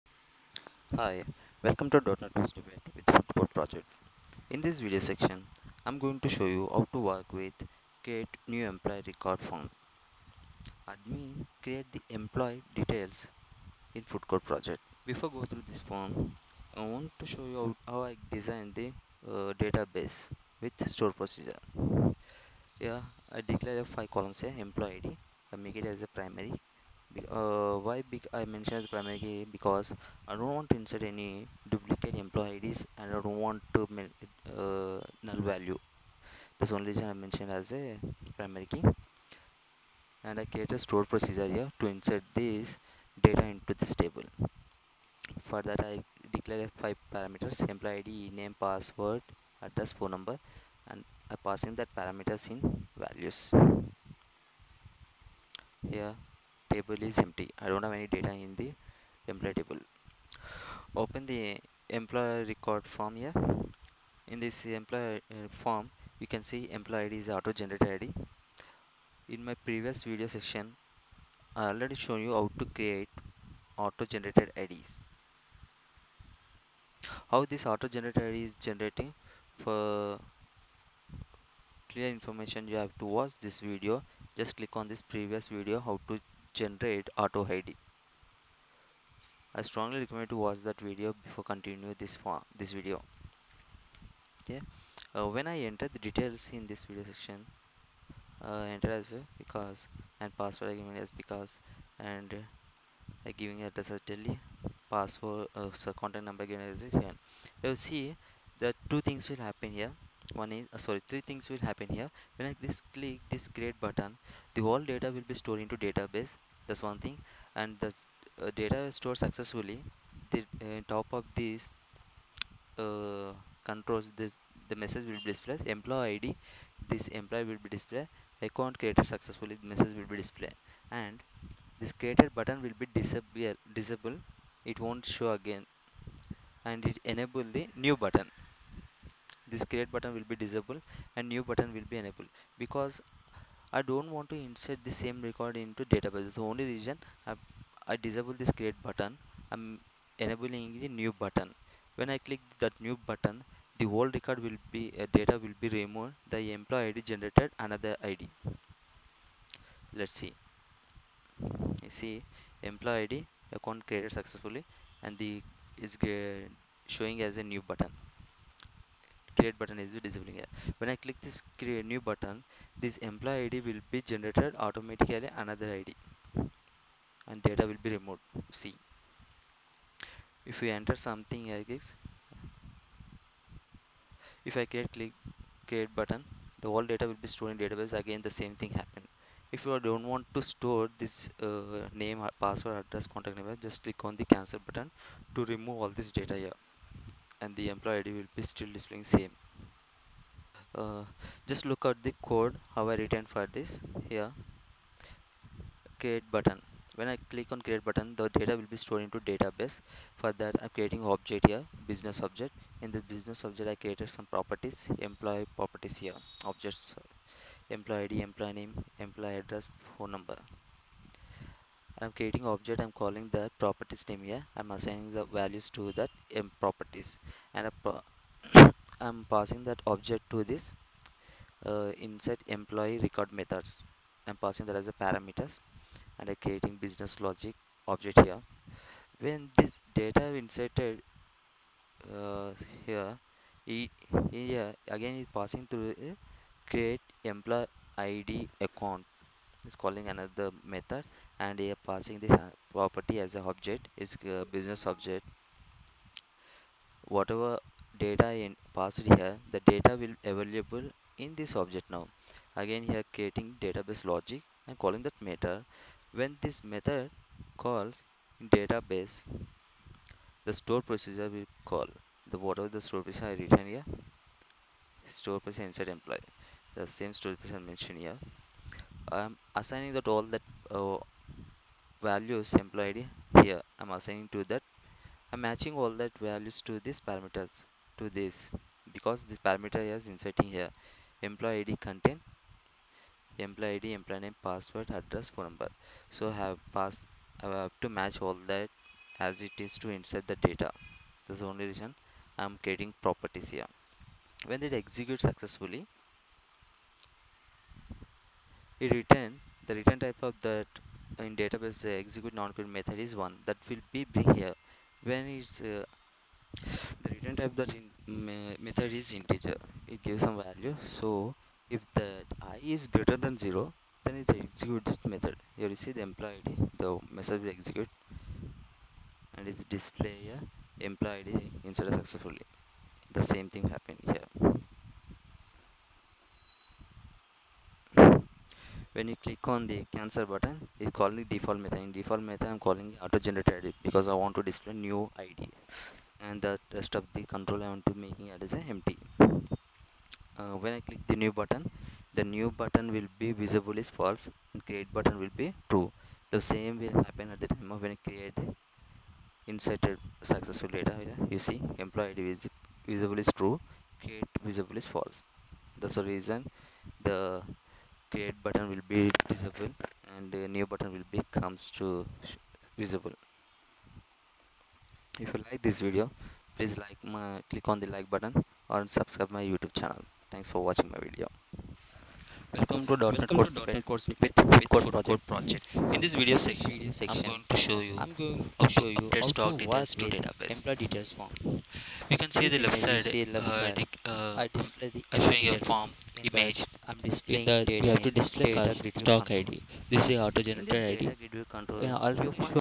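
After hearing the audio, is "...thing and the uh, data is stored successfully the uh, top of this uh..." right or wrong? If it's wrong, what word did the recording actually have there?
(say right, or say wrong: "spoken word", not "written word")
right.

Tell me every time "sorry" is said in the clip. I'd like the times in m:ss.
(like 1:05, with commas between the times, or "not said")
1:50.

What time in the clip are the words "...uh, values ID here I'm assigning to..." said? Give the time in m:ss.
4:40.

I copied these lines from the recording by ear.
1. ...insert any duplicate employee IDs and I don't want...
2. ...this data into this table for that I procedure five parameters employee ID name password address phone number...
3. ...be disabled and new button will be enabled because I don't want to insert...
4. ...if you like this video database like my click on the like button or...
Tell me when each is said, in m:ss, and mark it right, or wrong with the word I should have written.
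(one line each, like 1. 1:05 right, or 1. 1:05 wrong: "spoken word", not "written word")
1. 0:30 right
2. 0:42 wrong: "declare", not "procedure"
3. 2:20 right
4. 6:15 wrong: "please", not "database".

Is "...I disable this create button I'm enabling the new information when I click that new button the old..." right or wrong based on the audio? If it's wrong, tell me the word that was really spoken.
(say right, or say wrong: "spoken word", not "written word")
wrong: "button", not "information".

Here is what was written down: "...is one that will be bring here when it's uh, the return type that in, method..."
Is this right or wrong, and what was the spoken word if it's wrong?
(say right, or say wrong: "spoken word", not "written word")
right.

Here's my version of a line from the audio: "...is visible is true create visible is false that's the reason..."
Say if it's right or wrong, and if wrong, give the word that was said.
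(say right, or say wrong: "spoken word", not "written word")
right.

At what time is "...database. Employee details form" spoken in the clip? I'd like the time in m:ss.
6:30.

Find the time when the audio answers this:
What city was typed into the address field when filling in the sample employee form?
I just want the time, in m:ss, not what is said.
1:44.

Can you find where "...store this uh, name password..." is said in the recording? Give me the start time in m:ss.
3:10.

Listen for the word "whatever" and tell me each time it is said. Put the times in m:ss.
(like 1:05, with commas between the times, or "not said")
4:17, 4:32.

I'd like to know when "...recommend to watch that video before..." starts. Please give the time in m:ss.
1:30.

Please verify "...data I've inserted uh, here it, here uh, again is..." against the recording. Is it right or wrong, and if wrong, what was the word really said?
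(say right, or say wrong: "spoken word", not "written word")
right.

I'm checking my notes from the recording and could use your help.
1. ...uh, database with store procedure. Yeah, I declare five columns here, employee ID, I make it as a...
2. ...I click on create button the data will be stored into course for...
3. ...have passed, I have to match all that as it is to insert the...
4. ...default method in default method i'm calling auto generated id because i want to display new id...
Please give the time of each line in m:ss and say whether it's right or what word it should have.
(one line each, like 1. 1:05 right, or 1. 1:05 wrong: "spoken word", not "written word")
1. 0:19 right
2. 3:27 wrong: "database", not "course"
3. 4:56 right
4. 5:41 right.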